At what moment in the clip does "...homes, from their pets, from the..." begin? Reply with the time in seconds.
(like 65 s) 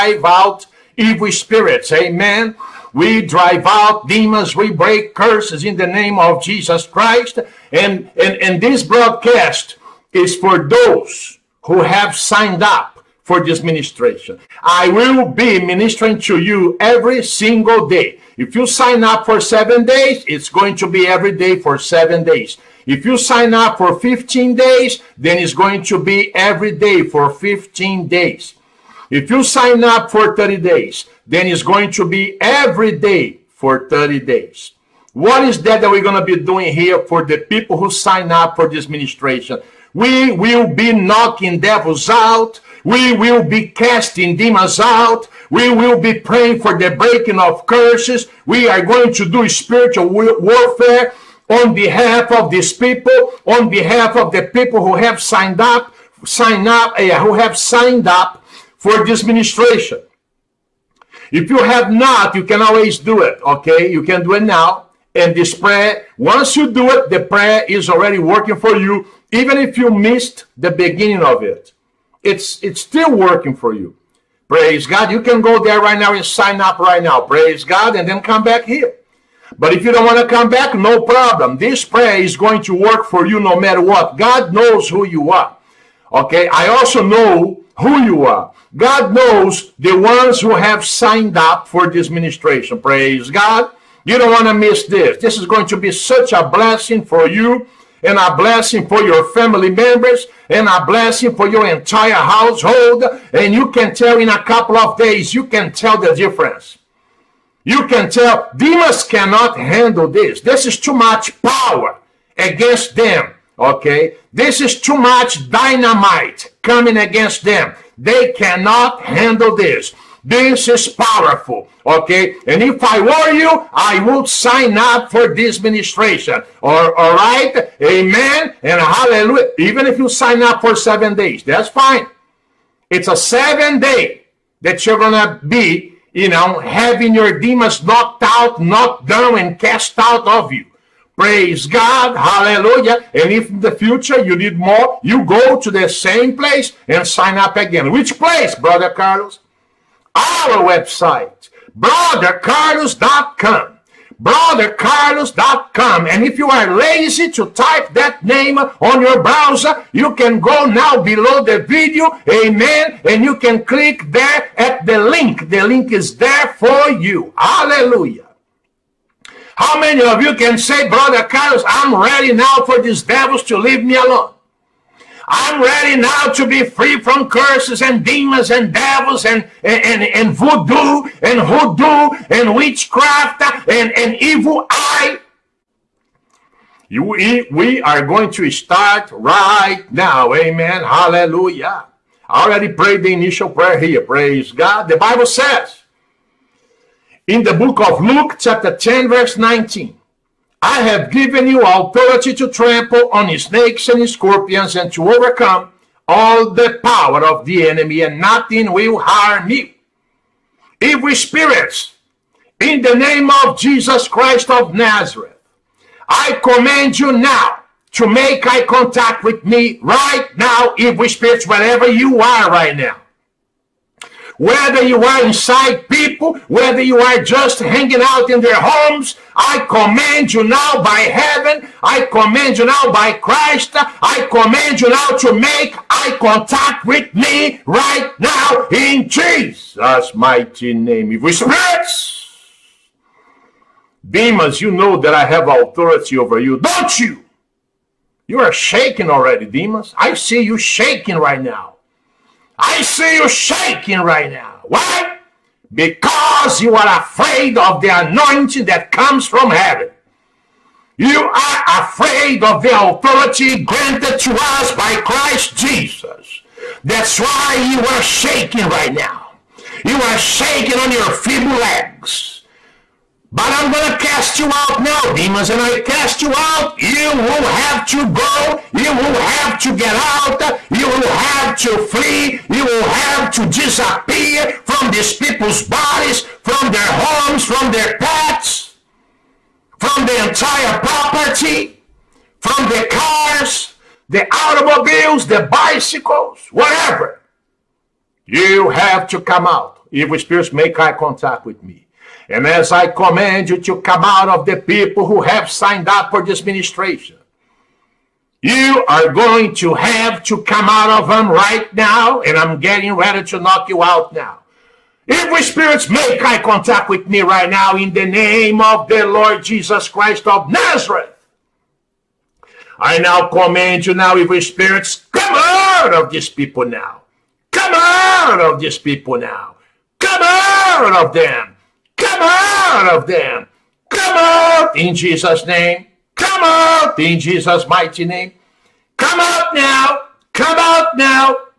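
286 s.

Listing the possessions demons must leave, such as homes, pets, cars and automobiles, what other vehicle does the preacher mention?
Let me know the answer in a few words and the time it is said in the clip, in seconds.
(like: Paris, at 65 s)
bicycles, at 295 s.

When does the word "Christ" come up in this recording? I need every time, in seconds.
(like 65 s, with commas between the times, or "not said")
6 s, 214 s, 233 s, 264 s, 319 s.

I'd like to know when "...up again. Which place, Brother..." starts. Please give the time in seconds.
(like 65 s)
147 s.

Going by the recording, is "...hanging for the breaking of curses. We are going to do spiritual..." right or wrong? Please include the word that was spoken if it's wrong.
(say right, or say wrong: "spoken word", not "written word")
wrong: "praying", not "hanging".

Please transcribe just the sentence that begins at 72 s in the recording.
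It's, it's still working for you.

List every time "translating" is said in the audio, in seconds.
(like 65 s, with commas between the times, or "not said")
not said.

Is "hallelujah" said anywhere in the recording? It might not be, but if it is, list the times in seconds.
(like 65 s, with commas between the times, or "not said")
128 s, 142 s, 167 s, 190 s.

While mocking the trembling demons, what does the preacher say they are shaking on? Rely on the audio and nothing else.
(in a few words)
feeble leg.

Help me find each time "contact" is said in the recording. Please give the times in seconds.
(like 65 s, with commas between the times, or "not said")
218 s, 236 s, 300 s, 316 s.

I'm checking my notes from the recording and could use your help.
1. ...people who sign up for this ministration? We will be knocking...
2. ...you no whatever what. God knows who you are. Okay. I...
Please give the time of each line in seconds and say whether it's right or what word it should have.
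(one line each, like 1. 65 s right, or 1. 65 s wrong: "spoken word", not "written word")
1. 37 s right
2. 83 s wrong: "matter", not "whatever".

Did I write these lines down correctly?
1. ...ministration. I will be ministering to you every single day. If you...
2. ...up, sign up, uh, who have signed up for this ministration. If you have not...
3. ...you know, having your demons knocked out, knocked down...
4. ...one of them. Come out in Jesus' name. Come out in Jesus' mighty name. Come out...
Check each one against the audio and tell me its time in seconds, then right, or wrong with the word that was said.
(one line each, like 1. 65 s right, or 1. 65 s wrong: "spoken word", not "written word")
1. 13 s right
2. 55 s right
3. 136 s right
4. 332 s right.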